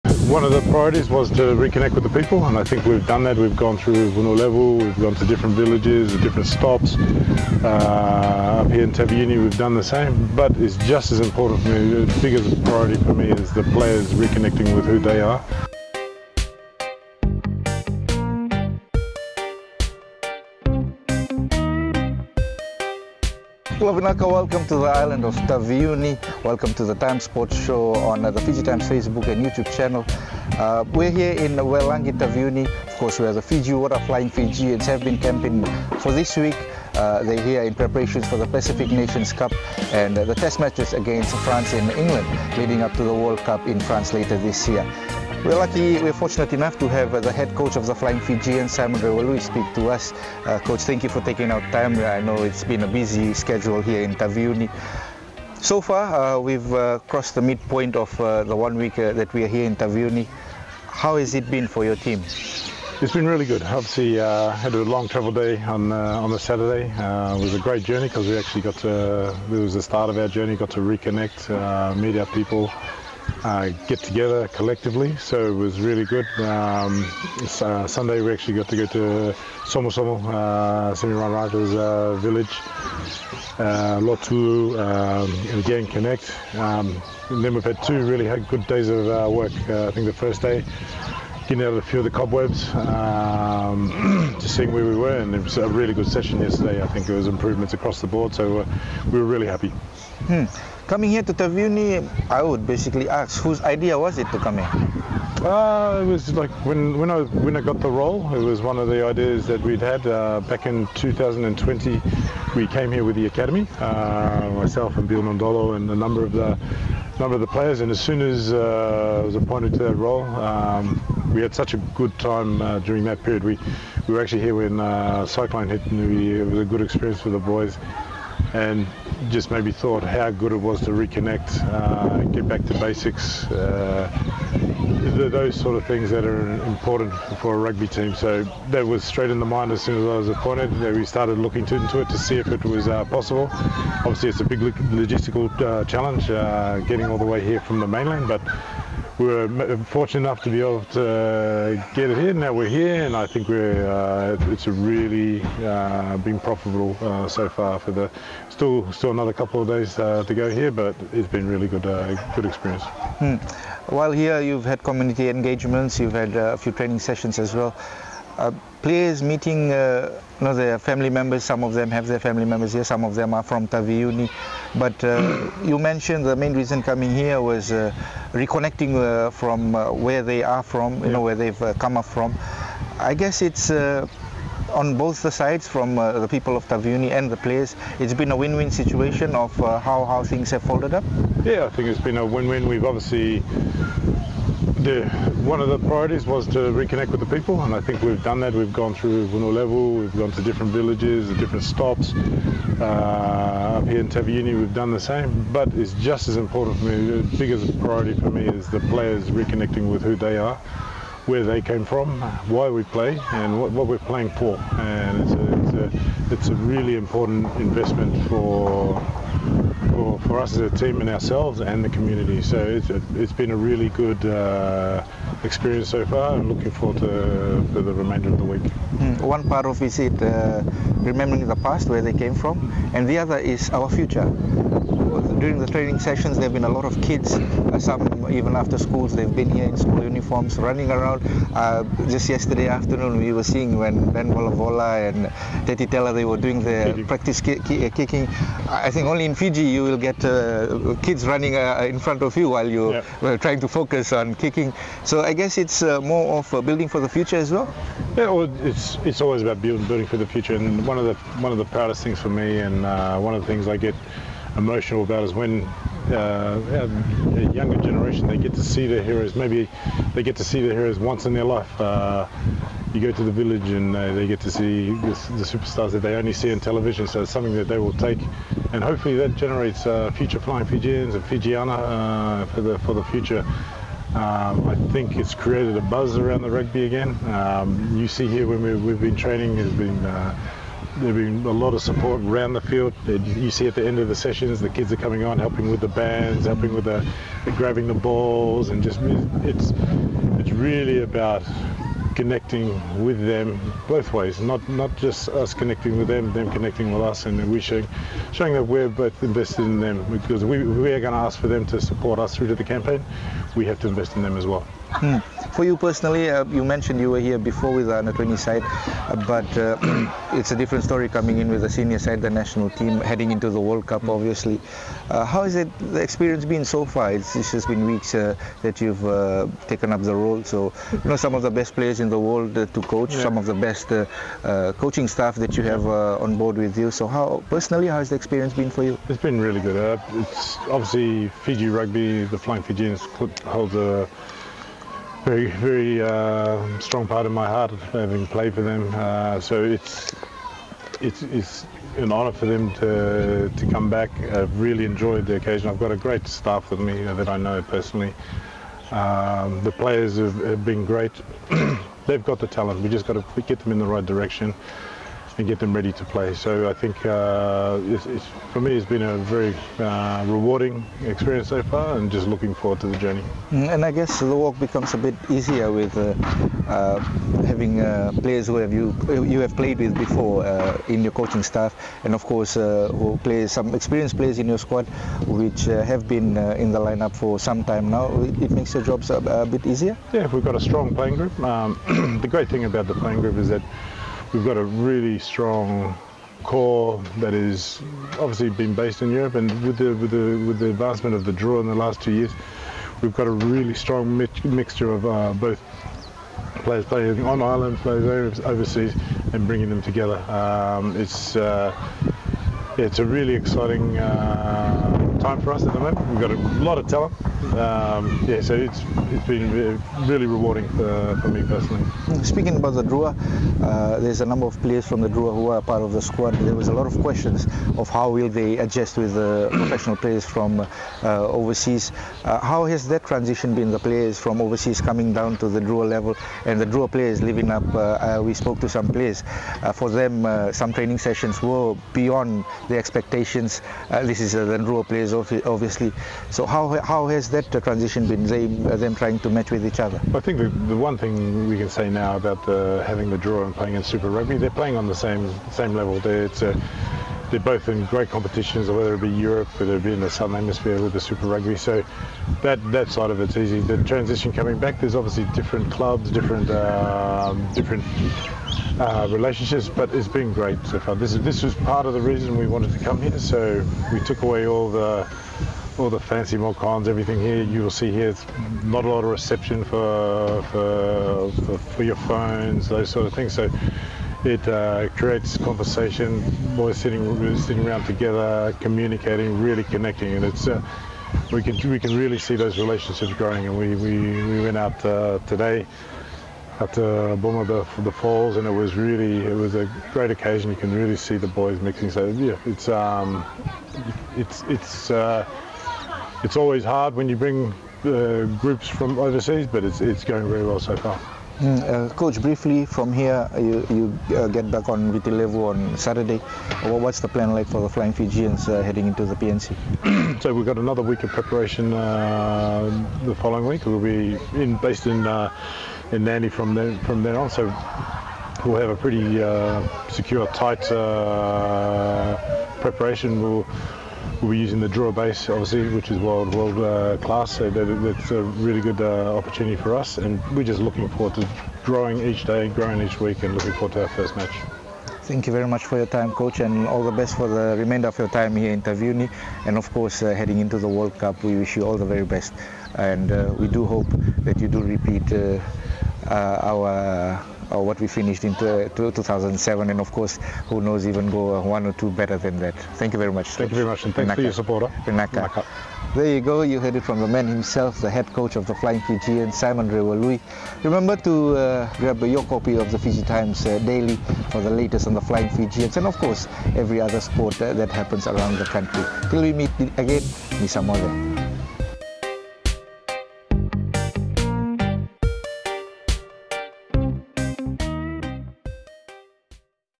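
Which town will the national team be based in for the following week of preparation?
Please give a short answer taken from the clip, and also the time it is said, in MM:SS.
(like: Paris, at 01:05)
Nadi, at 08:46.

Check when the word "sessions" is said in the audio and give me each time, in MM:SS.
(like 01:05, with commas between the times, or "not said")
01:36, 02:46, 03:55, 04:54, 07:20.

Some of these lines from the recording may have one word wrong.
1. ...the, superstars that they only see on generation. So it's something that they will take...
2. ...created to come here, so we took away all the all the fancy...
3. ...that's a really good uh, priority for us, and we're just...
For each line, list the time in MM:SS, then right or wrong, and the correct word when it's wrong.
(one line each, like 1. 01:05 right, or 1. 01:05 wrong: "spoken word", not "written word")
1. 04:35 wrong: "television", not "generation"
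2. 07:52 wrong: "wanted", not "created"
3. 08:57 wrong: "opportunity", not "priority".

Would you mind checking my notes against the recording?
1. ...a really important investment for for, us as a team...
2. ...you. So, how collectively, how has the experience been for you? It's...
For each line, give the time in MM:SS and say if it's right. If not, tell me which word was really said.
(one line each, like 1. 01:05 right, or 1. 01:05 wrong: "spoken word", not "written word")
1. 03:36 right
2. 05:36 wrong: "personally", not "collectively".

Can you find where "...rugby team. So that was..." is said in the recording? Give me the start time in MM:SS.
02:17.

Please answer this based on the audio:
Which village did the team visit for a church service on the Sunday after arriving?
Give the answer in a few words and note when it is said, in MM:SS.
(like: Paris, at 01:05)
Somo Somo, at 01:19.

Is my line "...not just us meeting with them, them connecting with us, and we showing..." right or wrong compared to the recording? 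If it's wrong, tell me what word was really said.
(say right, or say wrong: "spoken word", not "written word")
wrong: "connecting", not "meeting".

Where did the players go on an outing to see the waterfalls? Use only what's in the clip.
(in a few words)
Booma.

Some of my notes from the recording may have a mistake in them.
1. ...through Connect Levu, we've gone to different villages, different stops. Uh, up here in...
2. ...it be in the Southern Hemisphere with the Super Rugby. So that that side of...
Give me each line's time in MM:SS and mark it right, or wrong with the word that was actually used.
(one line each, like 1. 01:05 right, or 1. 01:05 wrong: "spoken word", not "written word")
1. 00:03 wrong: "Vanua", not "Connect"
2. 07:39 right.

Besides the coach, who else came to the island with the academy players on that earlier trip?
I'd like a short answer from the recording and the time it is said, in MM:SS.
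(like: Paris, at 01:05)
Bill Mondolo, at 01:55.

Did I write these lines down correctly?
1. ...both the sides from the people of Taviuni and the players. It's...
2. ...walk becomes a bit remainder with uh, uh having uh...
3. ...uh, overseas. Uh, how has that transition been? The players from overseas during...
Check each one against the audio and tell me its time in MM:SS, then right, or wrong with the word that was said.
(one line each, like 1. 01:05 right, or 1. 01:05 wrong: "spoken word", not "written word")
1. 03:04 right
2. 06:14 wrong: "easier", not "remainder"
3. 07:10 wrong: "coming", not "during".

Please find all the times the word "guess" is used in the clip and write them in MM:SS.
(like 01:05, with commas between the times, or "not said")
03:03, 04:15, 06:13.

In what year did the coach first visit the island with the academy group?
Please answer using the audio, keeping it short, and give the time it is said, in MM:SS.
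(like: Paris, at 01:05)
2020, at 01:50.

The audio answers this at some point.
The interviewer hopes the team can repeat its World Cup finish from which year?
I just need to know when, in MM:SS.
09:18.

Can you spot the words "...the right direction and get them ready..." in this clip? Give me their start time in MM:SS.
06:03.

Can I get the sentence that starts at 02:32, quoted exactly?
Now we're here, and I think we're uh, it's really uh, been profitable uh, so far.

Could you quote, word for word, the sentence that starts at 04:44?
Um, I think it's created a buzz around the rugby again.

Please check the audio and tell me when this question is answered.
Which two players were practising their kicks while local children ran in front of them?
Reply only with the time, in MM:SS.
04:04.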